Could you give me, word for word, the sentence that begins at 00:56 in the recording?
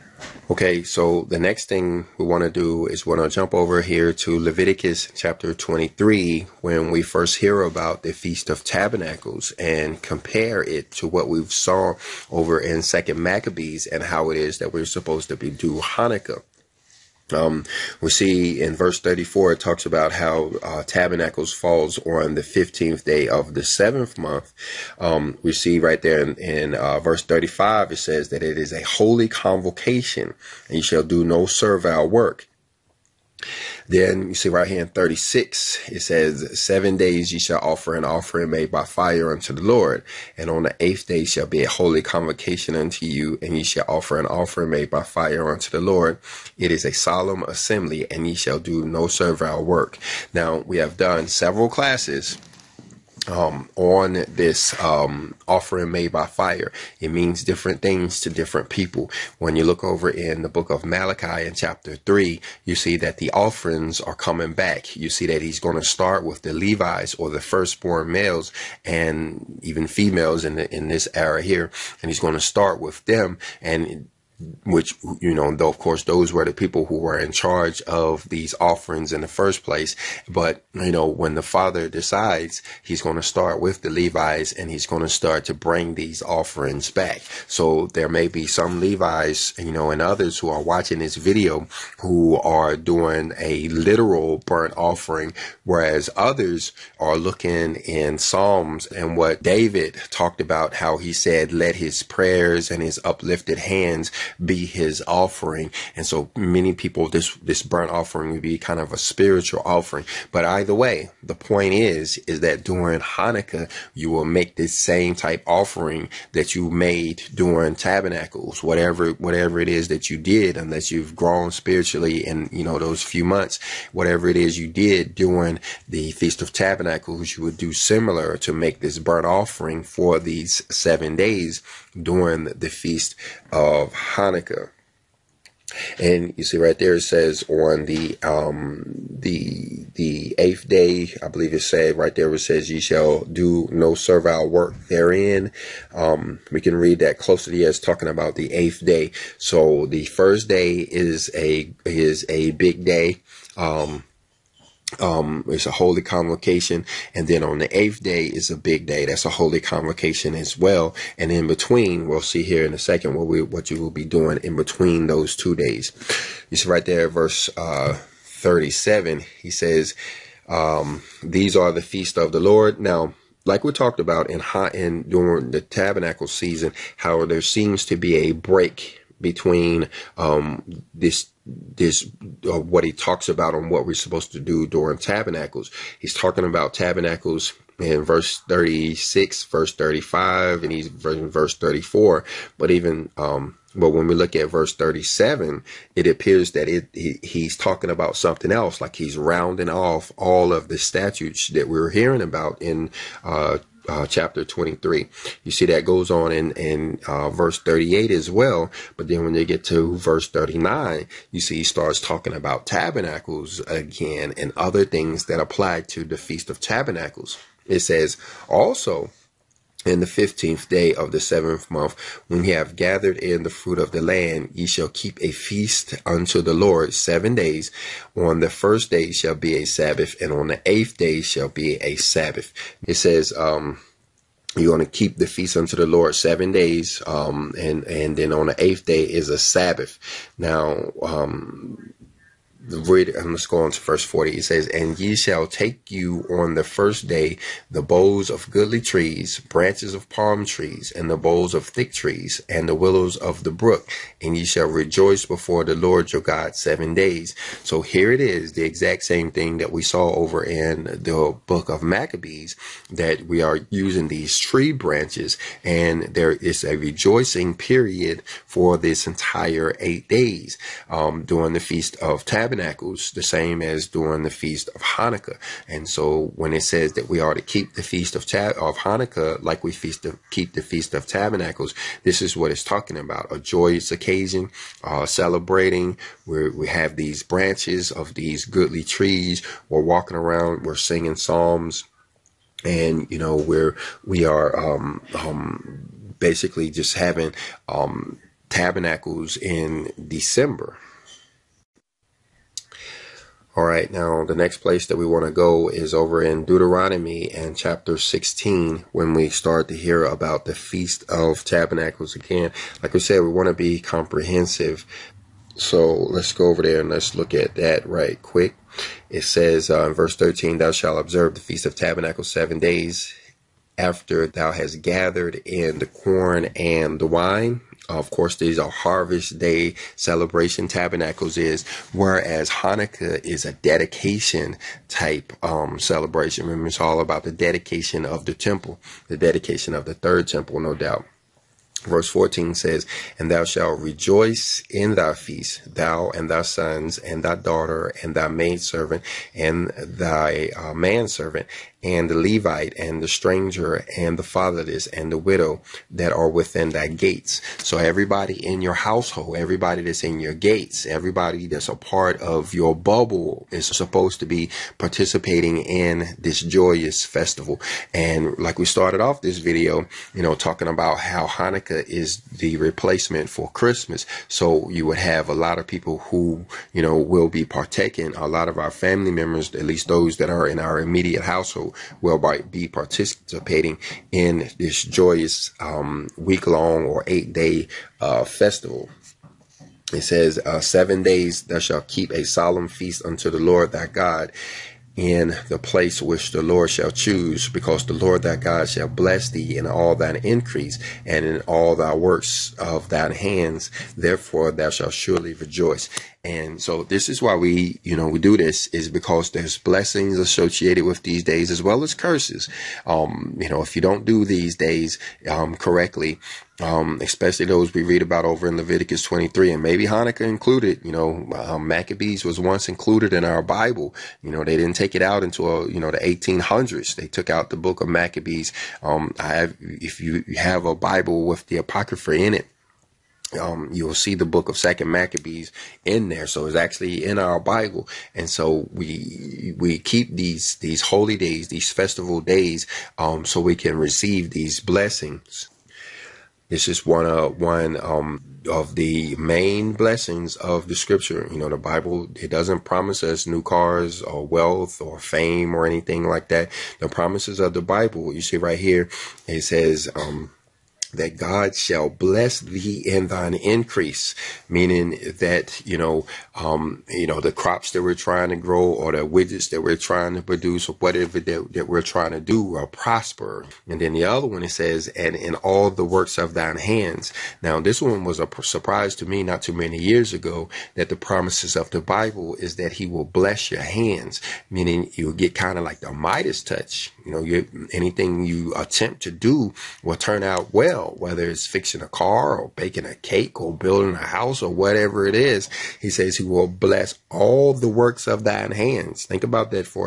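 It means different things to different people.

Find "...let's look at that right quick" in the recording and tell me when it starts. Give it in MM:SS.
05:16.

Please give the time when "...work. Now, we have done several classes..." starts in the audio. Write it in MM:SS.
00:49.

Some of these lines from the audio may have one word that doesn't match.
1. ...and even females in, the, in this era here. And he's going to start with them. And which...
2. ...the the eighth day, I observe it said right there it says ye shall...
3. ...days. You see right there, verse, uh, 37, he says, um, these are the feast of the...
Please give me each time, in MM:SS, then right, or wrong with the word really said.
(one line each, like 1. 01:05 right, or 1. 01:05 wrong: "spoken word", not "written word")
1. 01:08 right
2. 02:19 wrong: "believe", not "observe"
3. 02:45 right.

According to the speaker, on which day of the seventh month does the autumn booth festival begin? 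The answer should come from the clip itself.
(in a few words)
15th day.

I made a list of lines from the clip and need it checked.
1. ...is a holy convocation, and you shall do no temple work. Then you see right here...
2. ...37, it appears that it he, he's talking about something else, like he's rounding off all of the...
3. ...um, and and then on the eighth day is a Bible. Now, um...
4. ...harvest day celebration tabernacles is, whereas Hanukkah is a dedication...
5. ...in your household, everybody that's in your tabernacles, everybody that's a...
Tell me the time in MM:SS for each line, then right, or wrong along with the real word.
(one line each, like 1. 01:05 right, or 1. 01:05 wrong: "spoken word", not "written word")
1. 00:28 wrong: "servile", not "temple"
2. 03:14 right
3. 03:57 wrong: "Sabbath", not "Bible"
4. 05:28 right
5. 05:58 wrong: "gates", not "tabernacles".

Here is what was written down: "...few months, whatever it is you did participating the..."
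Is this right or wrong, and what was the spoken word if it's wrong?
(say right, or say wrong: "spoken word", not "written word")
wrong: "during", not "participating".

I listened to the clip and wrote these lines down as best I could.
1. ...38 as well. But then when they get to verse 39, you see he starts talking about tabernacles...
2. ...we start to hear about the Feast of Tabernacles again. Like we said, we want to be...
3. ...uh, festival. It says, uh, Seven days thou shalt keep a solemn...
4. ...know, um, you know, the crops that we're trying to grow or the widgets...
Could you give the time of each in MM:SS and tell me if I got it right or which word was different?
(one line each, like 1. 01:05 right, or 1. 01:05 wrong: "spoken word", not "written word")
1. 03:27 right
2. 05:09 right
3. 06:28 right
4. 07:45 right.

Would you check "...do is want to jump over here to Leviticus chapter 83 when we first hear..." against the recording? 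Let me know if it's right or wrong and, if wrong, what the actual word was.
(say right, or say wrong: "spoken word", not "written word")
wrong: "23", not "83".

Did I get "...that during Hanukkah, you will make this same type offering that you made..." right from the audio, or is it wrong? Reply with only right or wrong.
right.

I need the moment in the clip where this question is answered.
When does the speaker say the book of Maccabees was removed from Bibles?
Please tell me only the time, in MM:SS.
07:05.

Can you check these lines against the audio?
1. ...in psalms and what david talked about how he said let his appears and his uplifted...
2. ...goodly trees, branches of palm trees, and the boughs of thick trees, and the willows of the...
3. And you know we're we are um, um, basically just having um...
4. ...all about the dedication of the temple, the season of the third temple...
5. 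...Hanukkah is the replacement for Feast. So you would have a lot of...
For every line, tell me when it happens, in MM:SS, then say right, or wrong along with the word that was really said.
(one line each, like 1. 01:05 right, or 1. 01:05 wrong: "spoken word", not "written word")
1. 01:37 wrong: "prayers", not "appears"
2. 04:08 right
3. 04:52 right
4. 05:36 wrong: "dedication", not "season"
5. 06:11 wrong: "Christmas", not "Feast".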